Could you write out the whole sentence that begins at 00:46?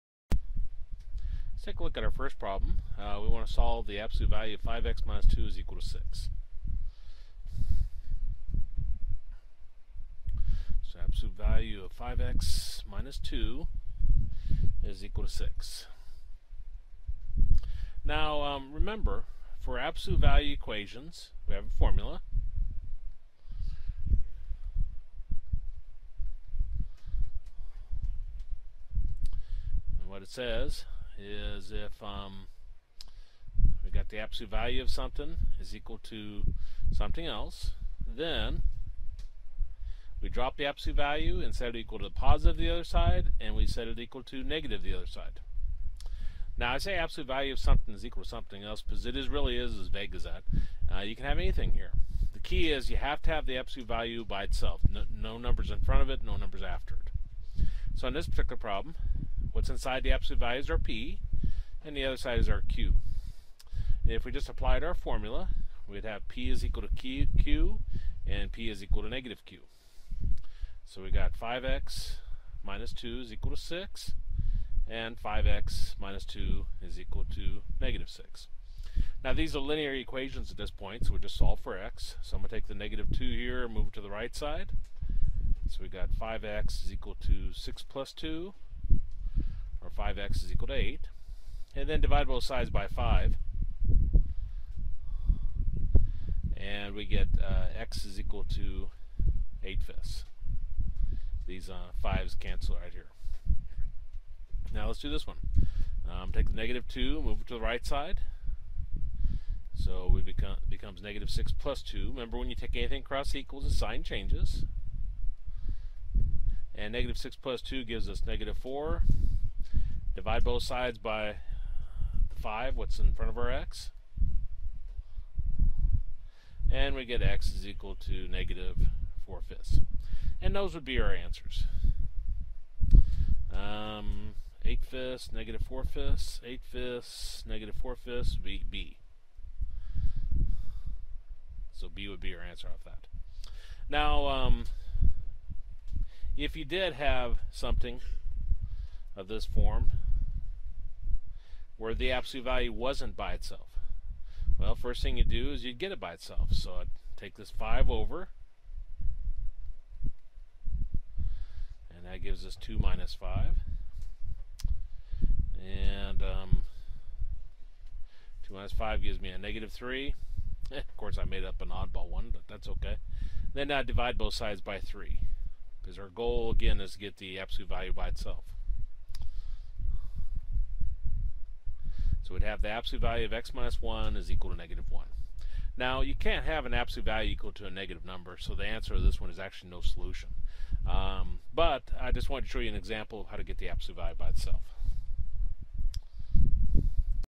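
Now I say absolute value of something is equal to something else because it is really is as vague as that.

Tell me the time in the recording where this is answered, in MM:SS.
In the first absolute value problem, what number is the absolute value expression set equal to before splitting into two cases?
00:05.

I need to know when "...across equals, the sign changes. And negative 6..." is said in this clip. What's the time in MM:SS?
01:53.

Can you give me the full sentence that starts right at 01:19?
Now these are linear equations at this point, so we just solve for x.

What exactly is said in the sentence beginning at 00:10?
So absolute value of 5x minus 2 is equal to 6.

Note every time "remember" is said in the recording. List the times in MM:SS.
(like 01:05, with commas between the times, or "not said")
00:18, 01:52.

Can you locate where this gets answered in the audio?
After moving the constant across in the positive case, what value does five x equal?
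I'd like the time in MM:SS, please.
01:29.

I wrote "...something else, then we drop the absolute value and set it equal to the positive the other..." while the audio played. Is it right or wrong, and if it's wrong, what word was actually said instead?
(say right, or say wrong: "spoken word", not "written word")
right.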